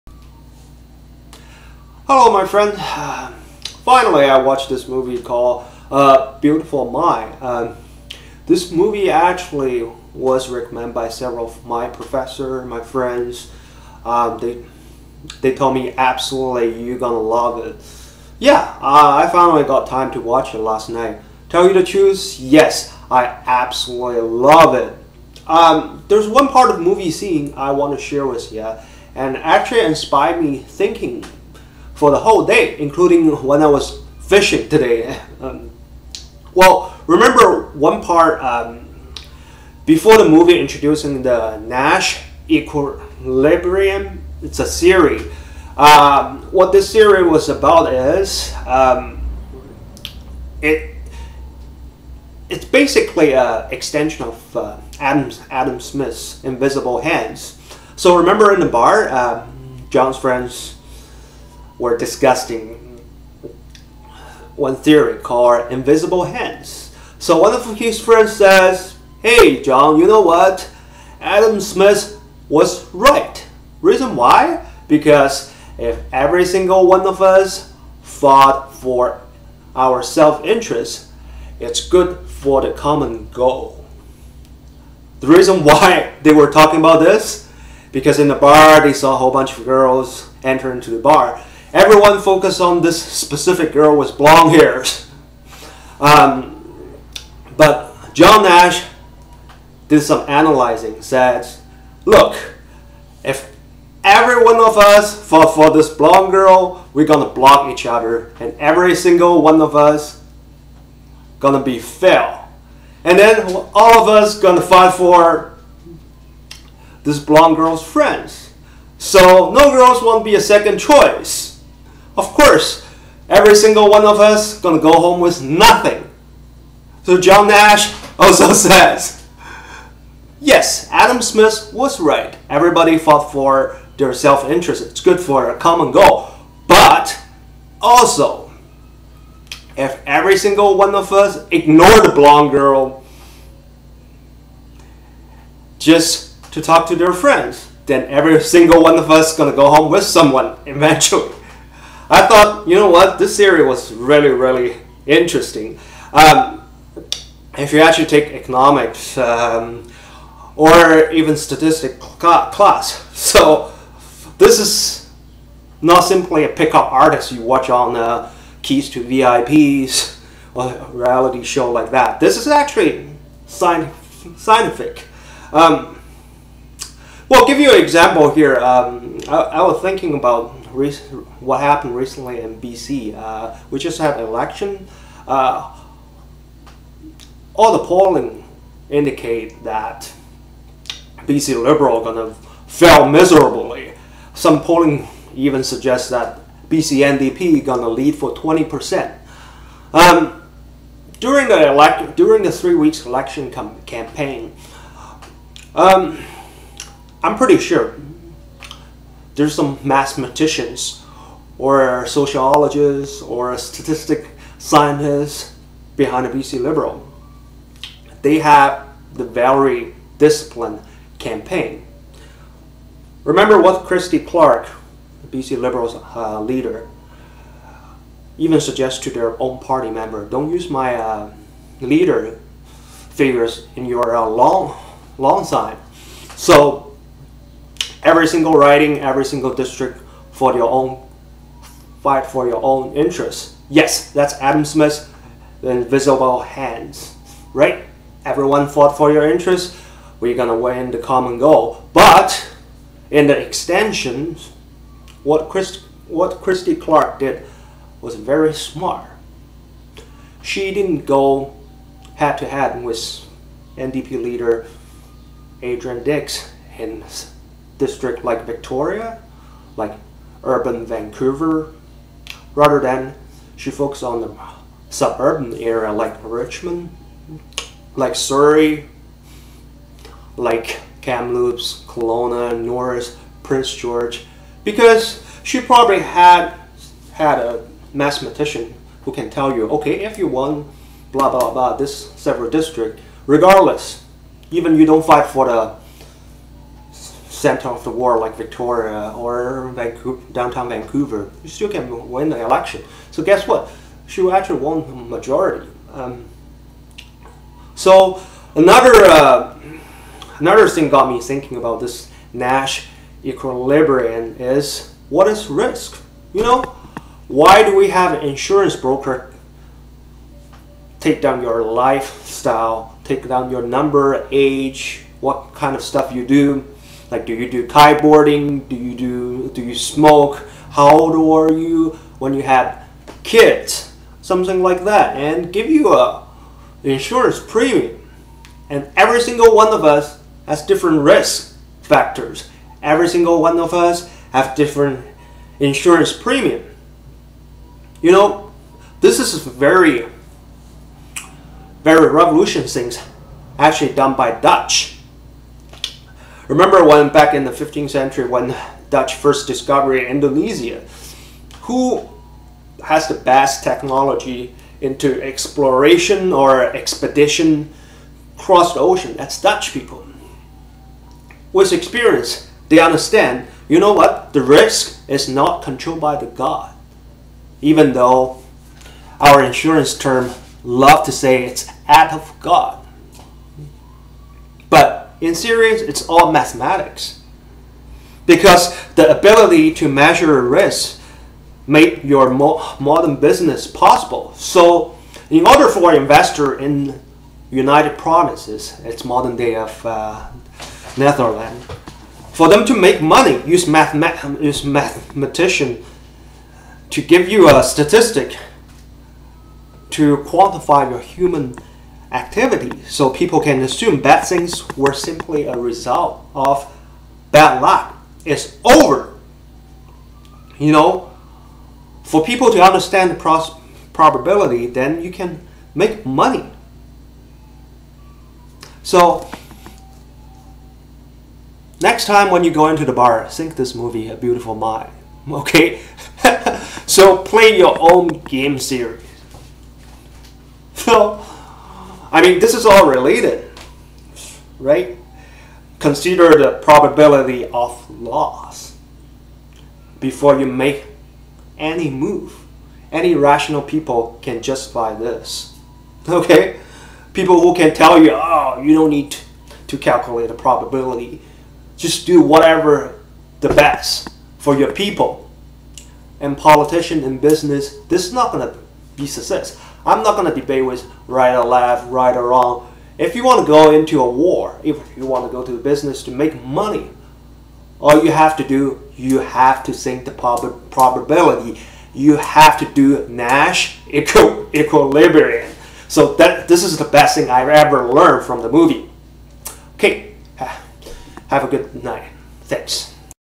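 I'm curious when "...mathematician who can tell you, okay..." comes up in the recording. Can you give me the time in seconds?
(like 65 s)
287 s.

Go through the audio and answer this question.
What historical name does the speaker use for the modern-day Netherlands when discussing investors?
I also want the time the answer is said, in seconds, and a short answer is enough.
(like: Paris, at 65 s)
United Provinces, at 397 s.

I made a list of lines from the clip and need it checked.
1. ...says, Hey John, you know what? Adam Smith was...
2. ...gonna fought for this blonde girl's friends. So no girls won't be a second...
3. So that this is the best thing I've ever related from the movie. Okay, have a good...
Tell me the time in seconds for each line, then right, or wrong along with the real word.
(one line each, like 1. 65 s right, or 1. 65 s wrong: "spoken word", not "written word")
1. 68 s right
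2. 114 s wrong: "fight", not "fought"
3. 485 s wrong: "learned", not "related".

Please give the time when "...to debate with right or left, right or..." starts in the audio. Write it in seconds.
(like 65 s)
470 s.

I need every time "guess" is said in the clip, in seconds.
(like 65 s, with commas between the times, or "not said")
303 s.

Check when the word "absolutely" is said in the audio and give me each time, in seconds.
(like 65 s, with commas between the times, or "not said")
15 s, 23 s.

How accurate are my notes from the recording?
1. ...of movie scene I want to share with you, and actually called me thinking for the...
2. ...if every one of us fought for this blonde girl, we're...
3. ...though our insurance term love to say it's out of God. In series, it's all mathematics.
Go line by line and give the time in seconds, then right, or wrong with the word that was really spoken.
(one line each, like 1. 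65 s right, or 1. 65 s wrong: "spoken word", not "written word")
1. 26 s wrong: "inspired", not "called"
2. 103 s right
3. 377 s right.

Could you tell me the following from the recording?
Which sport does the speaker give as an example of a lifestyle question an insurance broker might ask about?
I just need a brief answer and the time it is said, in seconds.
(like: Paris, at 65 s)
Kiteboarding, at 327 s.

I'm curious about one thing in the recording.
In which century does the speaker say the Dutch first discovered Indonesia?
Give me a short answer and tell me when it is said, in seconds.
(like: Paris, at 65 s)
15th century, at 357 s.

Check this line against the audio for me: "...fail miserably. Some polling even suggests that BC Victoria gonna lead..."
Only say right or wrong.
wrong.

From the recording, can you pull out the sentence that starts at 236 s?
So every single riding, every single district for your own fight for your own interests.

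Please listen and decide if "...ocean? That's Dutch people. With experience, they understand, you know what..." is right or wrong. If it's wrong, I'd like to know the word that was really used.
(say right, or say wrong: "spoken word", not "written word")
right.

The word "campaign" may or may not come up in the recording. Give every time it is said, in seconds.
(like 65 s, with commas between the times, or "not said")
203 s, 221 s.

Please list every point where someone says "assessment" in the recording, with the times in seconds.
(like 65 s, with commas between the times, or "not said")
not said.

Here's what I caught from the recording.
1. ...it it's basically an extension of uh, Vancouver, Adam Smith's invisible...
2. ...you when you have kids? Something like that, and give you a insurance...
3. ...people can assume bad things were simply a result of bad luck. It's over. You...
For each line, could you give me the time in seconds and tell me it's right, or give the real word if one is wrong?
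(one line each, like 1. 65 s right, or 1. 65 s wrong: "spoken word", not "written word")
1. 50 s wrong: "Adam", not "Vancouver"
2. 331 s right
3. 413 s right.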